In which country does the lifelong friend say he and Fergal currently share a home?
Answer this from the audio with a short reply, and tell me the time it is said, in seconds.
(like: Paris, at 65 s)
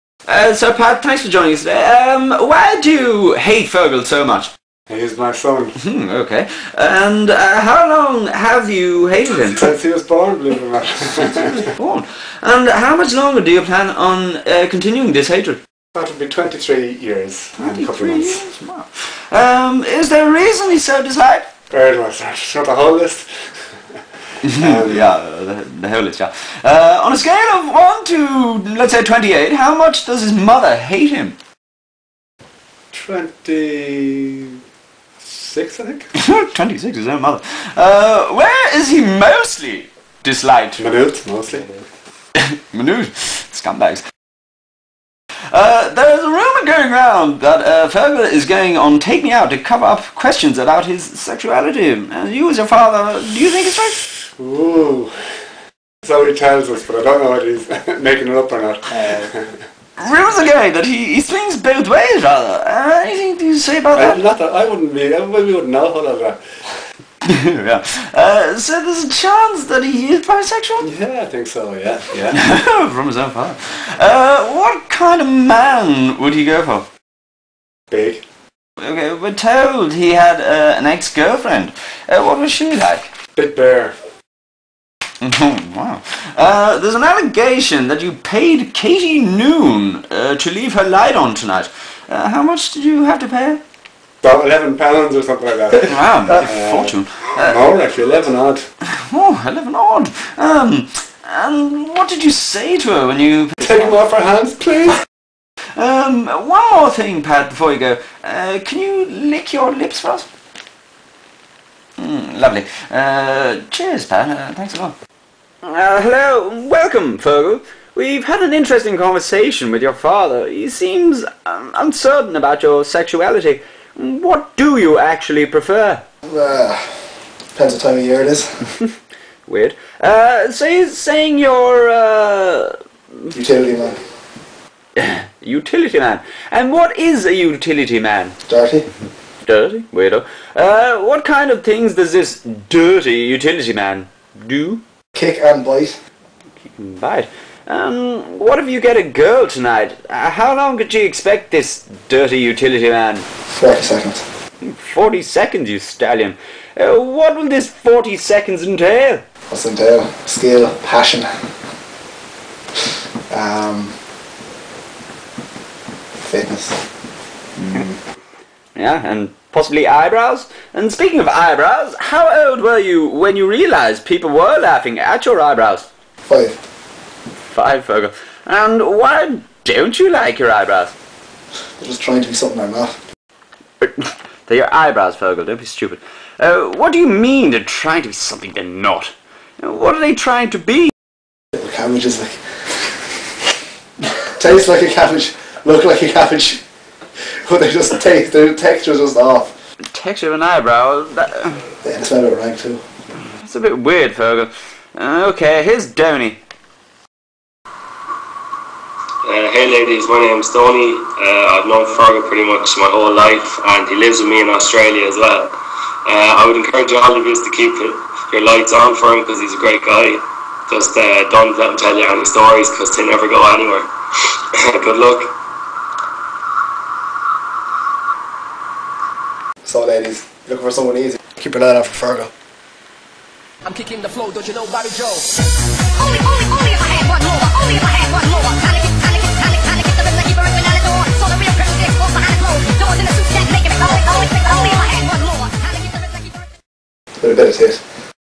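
Australia, at 214 s.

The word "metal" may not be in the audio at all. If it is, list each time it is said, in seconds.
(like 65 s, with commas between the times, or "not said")
not said.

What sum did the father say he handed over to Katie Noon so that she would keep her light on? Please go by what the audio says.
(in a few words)
About 11 pounds.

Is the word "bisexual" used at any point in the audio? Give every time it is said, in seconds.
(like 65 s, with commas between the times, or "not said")
70 s.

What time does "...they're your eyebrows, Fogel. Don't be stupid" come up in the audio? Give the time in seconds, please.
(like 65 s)
184 s.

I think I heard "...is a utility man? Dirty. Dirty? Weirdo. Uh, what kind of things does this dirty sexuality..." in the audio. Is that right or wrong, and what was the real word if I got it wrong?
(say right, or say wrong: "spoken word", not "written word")
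wrong: "utility", not "sexuality".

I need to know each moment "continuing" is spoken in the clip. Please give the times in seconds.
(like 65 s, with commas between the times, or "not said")
14 s.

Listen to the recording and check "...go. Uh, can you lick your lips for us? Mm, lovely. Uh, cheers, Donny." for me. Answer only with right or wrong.
wrong.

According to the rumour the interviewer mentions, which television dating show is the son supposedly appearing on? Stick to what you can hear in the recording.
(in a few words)
Take Me Out.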